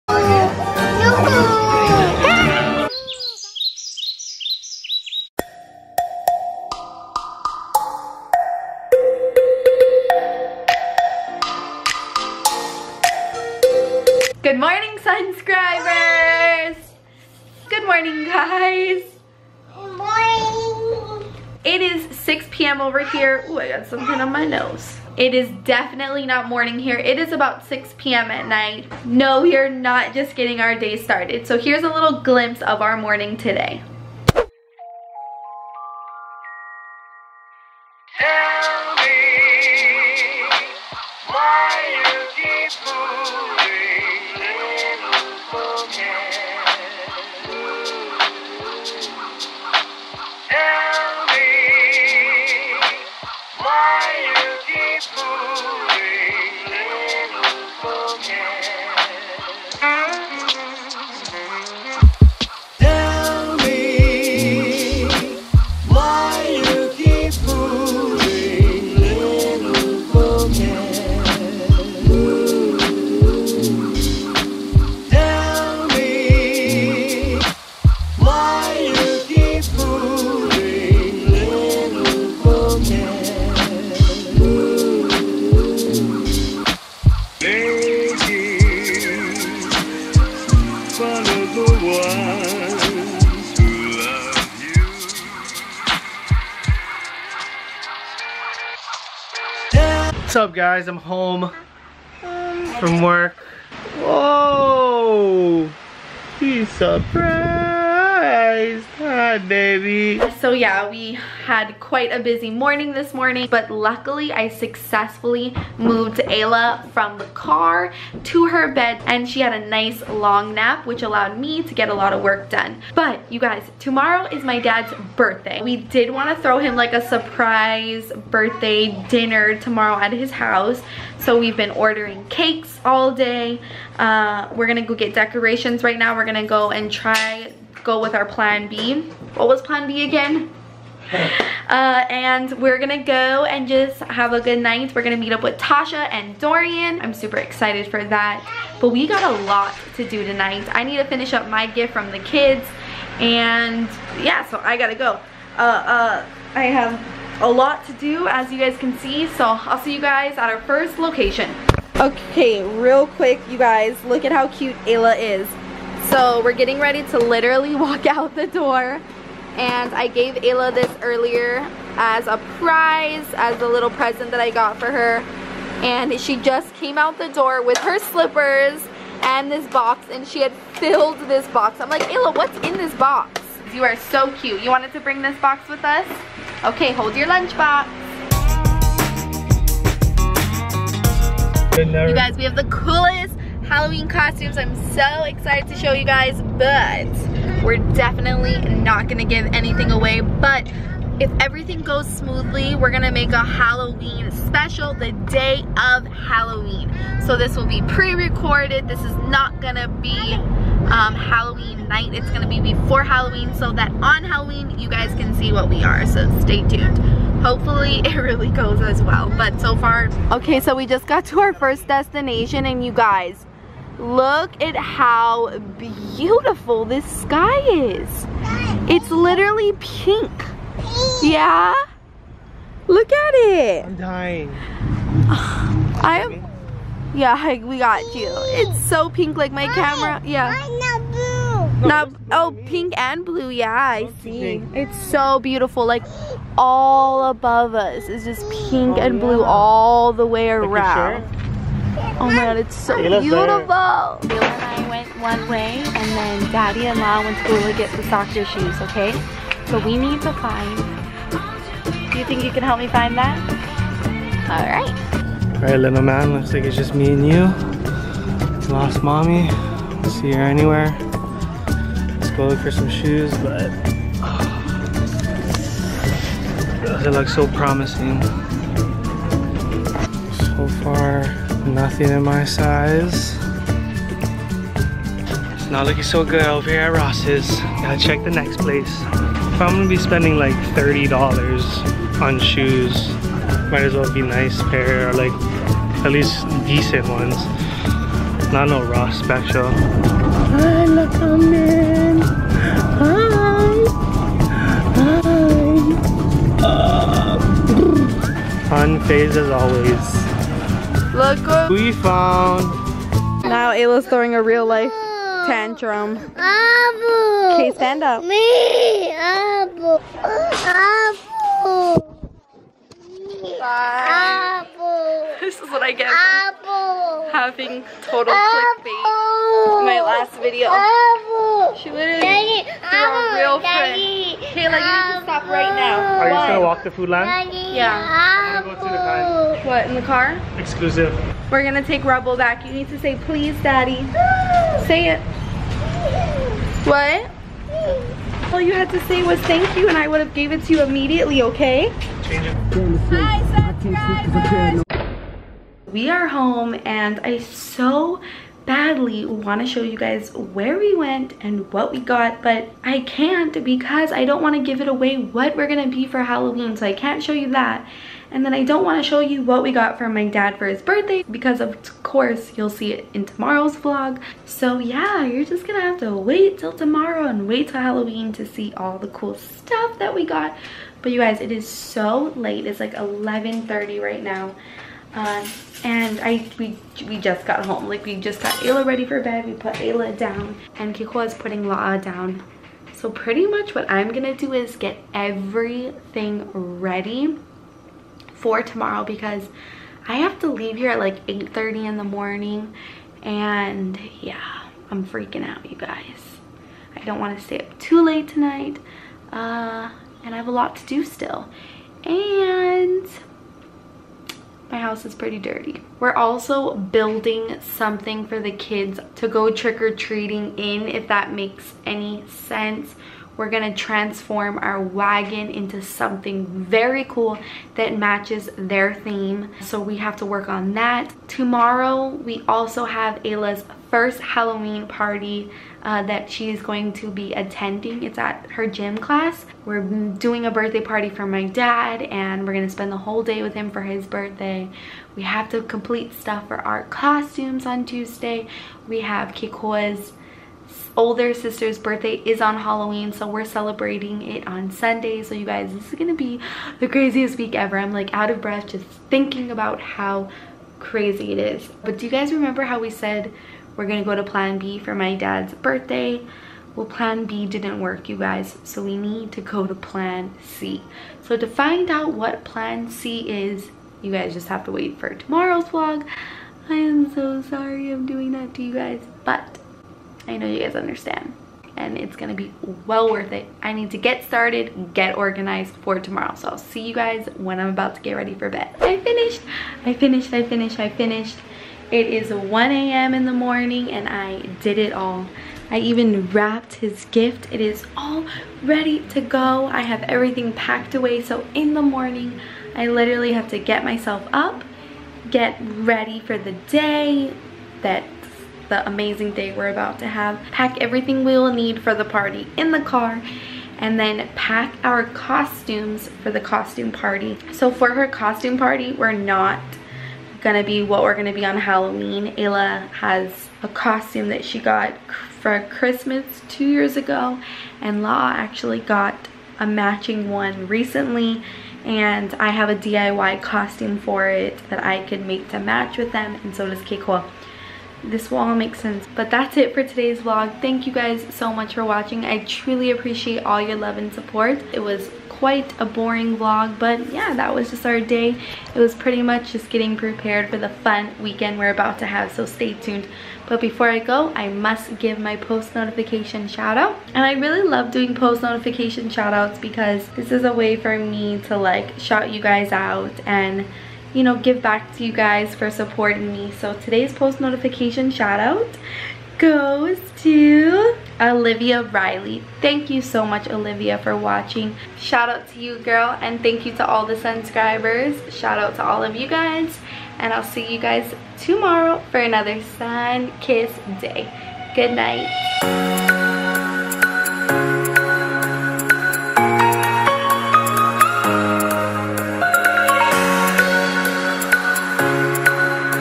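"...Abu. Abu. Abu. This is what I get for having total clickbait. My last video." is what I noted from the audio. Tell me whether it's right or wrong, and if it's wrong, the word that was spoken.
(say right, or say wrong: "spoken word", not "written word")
right.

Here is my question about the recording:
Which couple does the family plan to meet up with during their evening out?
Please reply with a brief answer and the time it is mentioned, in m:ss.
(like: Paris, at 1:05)
Tasha and Dorian, at 2:25.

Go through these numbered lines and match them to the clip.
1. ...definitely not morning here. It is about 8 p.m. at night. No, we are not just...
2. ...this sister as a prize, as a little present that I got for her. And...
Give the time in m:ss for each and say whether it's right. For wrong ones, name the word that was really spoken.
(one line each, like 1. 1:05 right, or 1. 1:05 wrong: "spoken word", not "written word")
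1. 0:25 wrong: "6", not "8"
2. 2:50 wrong: "earlier", not "sister".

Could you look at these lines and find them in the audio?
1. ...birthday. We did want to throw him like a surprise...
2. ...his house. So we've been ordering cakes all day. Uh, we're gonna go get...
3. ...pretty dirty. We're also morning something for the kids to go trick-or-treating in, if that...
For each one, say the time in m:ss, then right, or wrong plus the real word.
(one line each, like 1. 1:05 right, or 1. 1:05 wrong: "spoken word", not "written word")
1. 2:05 right
2. 2:10 right
3. 6:55 wrong: "building", not "morning".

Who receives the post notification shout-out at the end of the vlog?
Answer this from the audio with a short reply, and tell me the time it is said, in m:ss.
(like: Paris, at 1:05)
Olivia Riley, at 9:31.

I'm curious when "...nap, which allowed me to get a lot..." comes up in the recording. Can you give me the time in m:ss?
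2:00.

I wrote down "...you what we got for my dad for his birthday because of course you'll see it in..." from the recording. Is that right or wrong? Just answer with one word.
right.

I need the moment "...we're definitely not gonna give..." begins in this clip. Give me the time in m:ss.
3:17.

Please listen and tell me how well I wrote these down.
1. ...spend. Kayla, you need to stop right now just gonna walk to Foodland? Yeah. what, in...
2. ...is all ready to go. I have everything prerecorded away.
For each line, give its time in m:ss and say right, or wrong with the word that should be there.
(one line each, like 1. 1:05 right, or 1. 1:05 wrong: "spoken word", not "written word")
1. 5:34 wrong: "friend", not "spend"
2. 8:17 wrong: "packed", not "prerecorded".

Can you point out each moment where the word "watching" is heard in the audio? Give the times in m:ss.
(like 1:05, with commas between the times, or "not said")
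9:01, 9:34.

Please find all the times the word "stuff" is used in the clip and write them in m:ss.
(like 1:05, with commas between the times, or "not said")
6:19, 7:26.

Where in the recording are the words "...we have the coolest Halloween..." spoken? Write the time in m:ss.
3:12.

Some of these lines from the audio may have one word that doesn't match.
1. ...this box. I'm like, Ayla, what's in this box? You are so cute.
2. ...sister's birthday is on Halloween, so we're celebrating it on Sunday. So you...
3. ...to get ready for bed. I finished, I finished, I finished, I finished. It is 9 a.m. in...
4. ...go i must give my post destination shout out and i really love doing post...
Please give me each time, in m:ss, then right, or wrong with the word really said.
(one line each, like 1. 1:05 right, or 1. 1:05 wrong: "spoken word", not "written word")
1. 3:01 right
2. 7:31 right
3. 8:07 wrong: "1", not "9"
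4. 9:13 wrong: "notification", not "destination".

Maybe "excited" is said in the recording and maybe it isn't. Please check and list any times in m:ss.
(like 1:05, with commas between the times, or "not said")
2:27, 3:15.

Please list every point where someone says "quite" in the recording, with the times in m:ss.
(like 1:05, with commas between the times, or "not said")
1:51, 9:05.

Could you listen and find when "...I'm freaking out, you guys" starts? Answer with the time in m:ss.
6:44.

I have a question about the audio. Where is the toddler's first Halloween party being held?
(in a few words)
Her gym class.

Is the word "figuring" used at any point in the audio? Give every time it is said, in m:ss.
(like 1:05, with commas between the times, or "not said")
not said.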